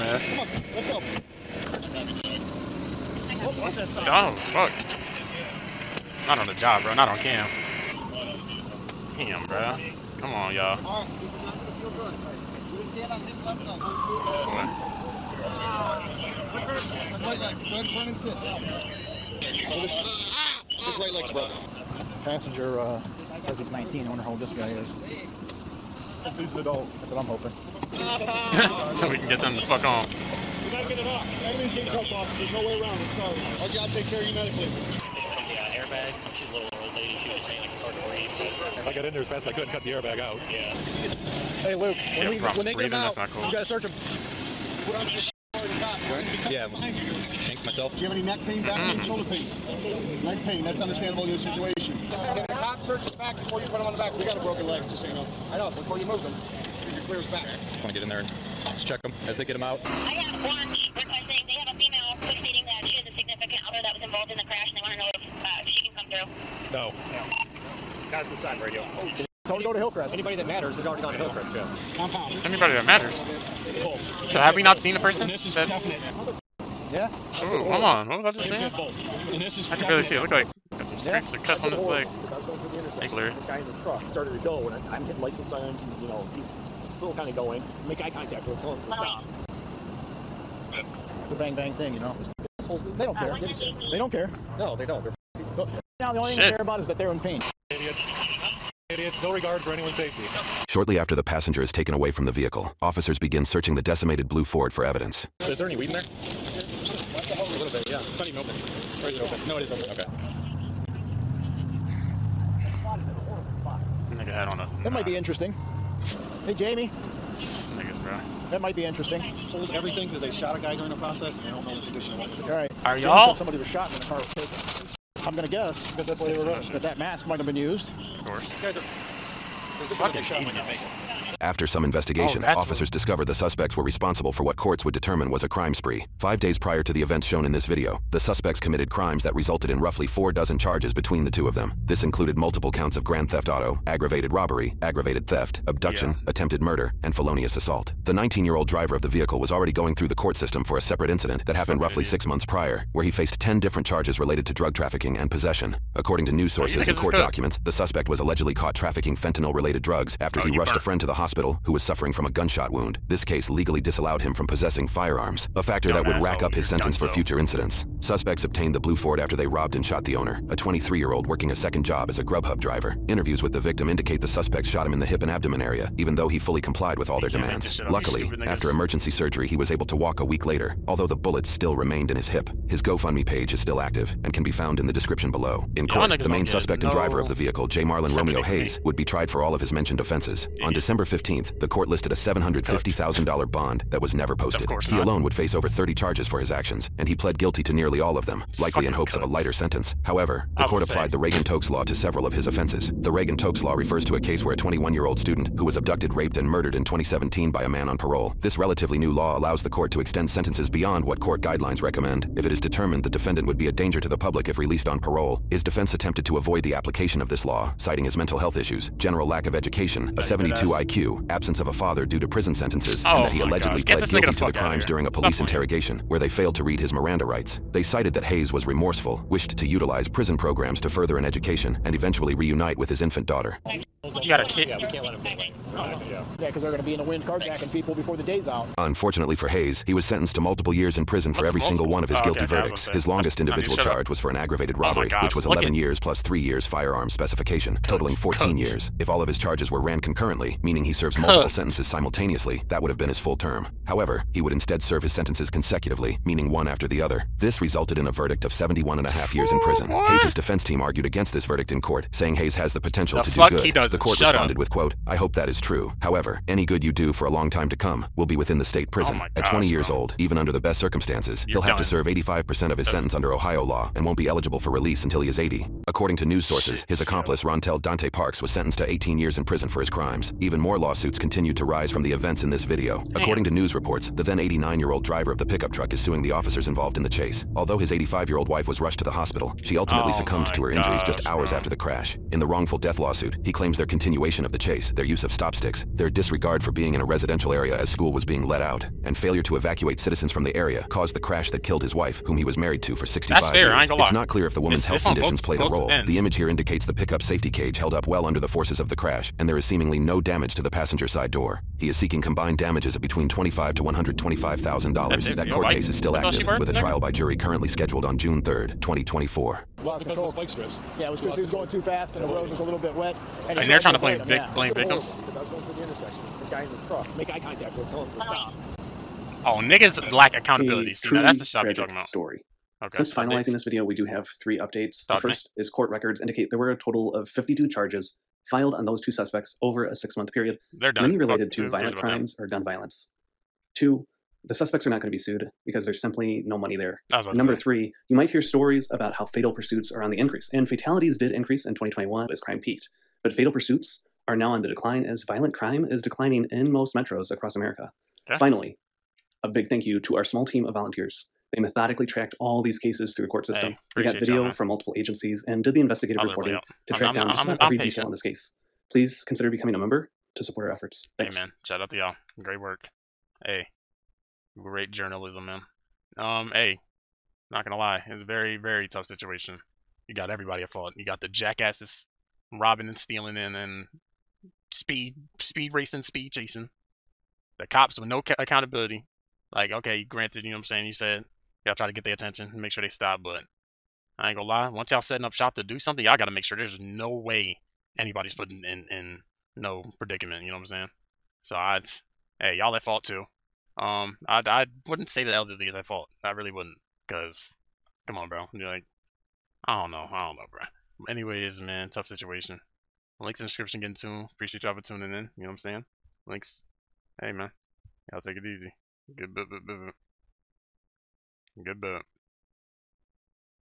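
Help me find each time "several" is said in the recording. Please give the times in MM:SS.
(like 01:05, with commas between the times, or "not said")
03:21.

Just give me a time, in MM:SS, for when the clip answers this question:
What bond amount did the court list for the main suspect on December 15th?
03:12.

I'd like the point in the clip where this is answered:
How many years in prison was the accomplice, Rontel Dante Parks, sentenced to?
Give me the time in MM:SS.
04:38.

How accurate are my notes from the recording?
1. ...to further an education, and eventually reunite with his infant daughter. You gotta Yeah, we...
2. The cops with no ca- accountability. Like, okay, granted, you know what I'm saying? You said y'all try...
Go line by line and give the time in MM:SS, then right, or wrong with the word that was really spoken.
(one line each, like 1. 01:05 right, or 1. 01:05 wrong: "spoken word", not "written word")
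1. 03:50 right
2. 06:27 right.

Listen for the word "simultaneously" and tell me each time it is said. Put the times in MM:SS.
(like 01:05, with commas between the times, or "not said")
04:11.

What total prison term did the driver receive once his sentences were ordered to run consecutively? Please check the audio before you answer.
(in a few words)
71 and a half years.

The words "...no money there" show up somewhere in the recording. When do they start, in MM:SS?
05:46.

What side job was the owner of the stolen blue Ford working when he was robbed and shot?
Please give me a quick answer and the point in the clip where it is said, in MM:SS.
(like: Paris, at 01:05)
Grubhub driver, at 02:52.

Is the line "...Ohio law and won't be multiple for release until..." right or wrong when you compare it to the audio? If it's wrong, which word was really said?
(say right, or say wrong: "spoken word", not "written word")
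wrong: "eligible", not "multiple".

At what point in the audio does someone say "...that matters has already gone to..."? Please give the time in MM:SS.
01:10.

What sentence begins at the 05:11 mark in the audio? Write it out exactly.
He is seeking combined damages of between 25 to $125,000.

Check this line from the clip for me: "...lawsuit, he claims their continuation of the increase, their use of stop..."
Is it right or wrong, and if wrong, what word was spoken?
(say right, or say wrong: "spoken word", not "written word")
wrong: "chase", not "increase".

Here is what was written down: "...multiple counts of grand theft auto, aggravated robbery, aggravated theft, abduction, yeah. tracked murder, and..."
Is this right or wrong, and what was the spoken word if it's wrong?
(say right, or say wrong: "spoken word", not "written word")
wrong: "attempted", not "tracked".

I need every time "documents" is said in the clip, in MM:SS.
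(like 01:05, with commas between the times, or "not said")
02:37.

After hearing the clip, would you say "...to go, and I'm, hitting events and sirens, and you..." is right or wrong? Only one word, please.
wrong.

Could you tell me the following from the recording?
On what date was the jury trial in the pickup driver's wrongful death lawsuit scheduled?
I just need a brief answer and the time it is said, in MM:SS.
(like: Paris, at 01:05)
June 3rd, 2024, at 05:18.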